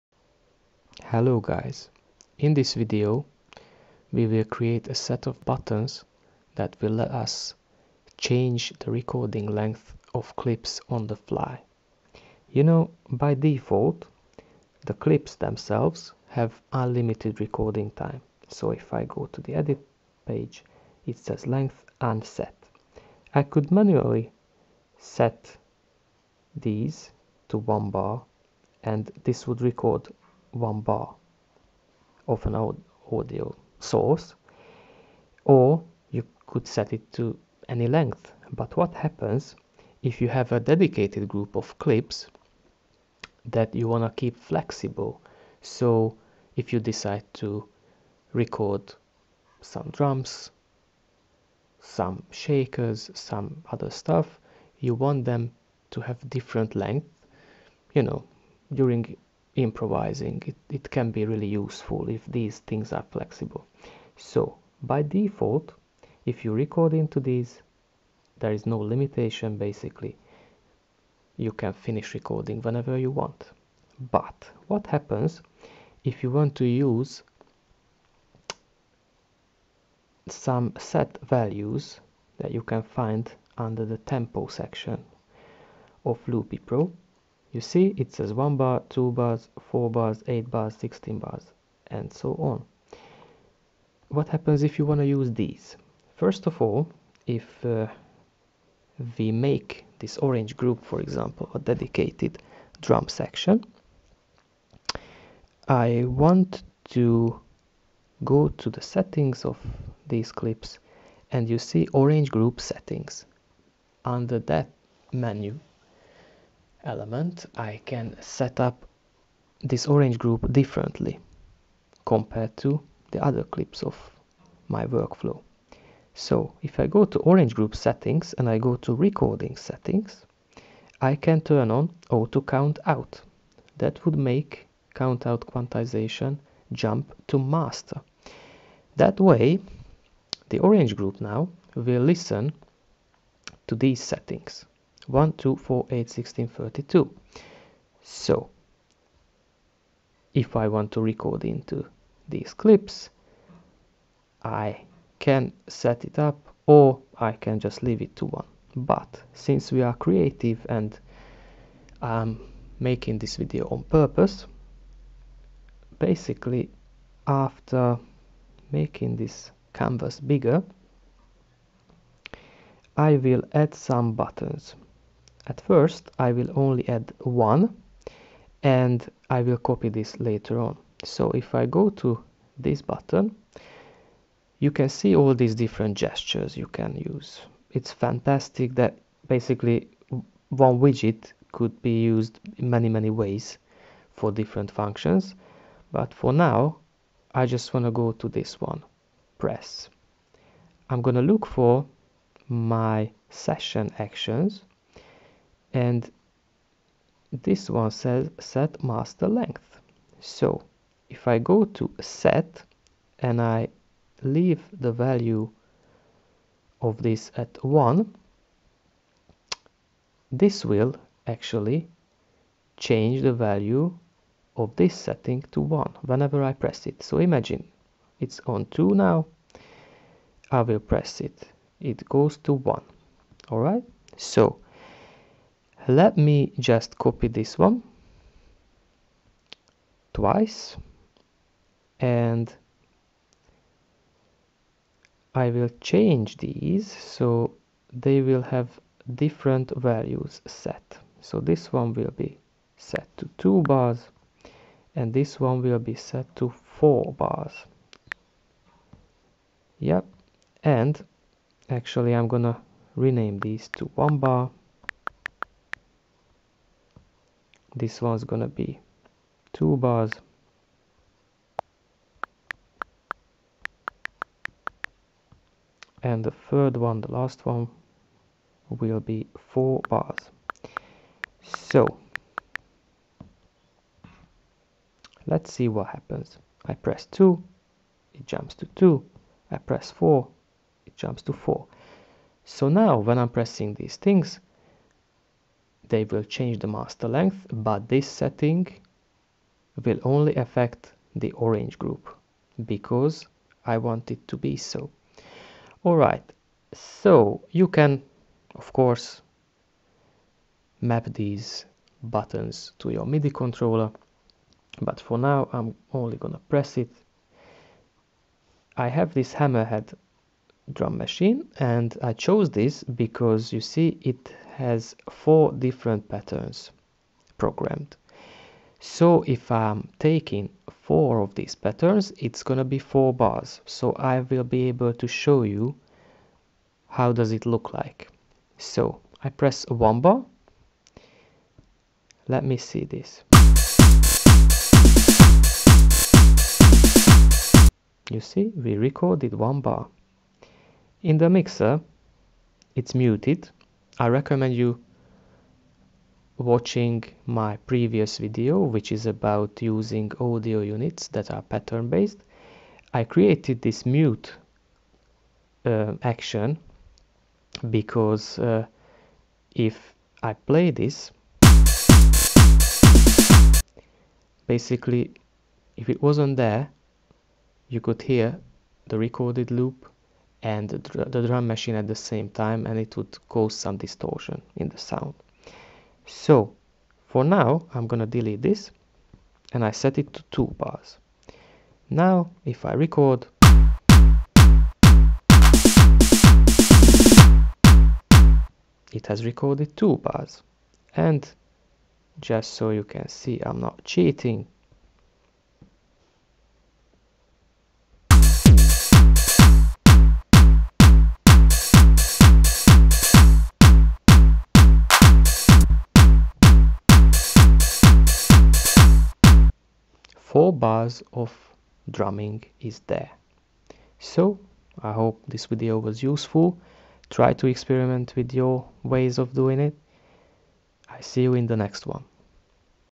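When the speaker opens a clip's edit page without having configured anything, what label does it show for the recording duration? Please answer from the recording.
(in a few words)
length unset.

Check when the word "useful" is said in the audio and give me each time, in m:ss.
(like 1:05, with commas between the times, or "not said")
1:01, 7:06.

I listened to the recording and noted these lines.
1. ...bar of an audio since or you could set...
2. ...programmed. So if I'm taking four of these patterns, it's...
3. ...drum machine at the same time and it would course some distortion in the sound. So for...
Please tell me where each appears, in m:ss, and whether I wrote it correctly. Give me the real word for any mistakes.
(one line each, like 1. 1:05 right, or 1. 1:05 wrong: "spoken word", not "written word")
1. 0:30 wrong: "source", not "since"
2. 5:27 right
3. 6:21 wrong: "cause", not "course".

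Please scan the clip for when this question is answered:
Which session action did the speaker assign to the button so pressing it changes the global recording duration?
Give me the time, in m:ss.
3:28.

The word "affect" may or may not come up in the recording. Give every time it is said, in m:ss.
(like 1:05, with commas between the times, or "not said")
5:00.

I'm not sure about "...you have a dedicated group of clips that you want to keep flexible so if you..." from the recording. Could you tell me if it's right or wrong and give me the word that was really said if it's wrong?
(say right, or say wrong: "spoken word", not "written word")
right.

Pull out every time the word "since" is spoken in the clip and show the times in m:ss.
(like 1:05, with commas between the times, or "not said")
2:39.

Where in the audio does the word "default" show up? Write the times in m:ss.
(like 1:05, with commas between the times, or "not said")
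0:13, 1:05.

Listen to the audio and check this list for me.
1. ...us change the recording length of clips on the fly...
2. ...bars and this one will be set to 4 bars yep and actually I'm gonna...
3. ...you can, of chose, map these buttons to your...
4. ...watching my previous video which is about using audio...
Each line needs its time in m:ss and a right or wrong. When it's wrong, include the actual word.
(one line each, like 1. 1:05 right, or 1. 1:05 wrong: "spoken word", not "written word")
1. 0:07 right
2. 4:13 right
3. 5:07 wrong: "course", not "chose"
4. 5:56 right.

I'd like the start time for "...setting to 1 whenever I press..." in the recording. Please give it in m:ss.
3:44.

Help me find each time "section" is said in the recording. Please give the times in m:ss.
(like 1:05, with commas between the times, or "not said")
1:24, 1:43.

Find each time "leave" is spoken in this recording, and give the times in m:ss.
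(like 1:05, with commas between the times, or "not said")
2:37, 3:34.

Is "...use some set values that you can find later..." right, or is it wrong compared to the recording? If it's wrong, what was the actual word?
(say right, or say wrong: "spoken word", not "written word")
wrong: "under", not "later".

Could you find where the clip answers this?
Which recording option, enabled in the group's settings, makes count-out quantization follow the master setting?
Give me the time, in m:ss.
2:12.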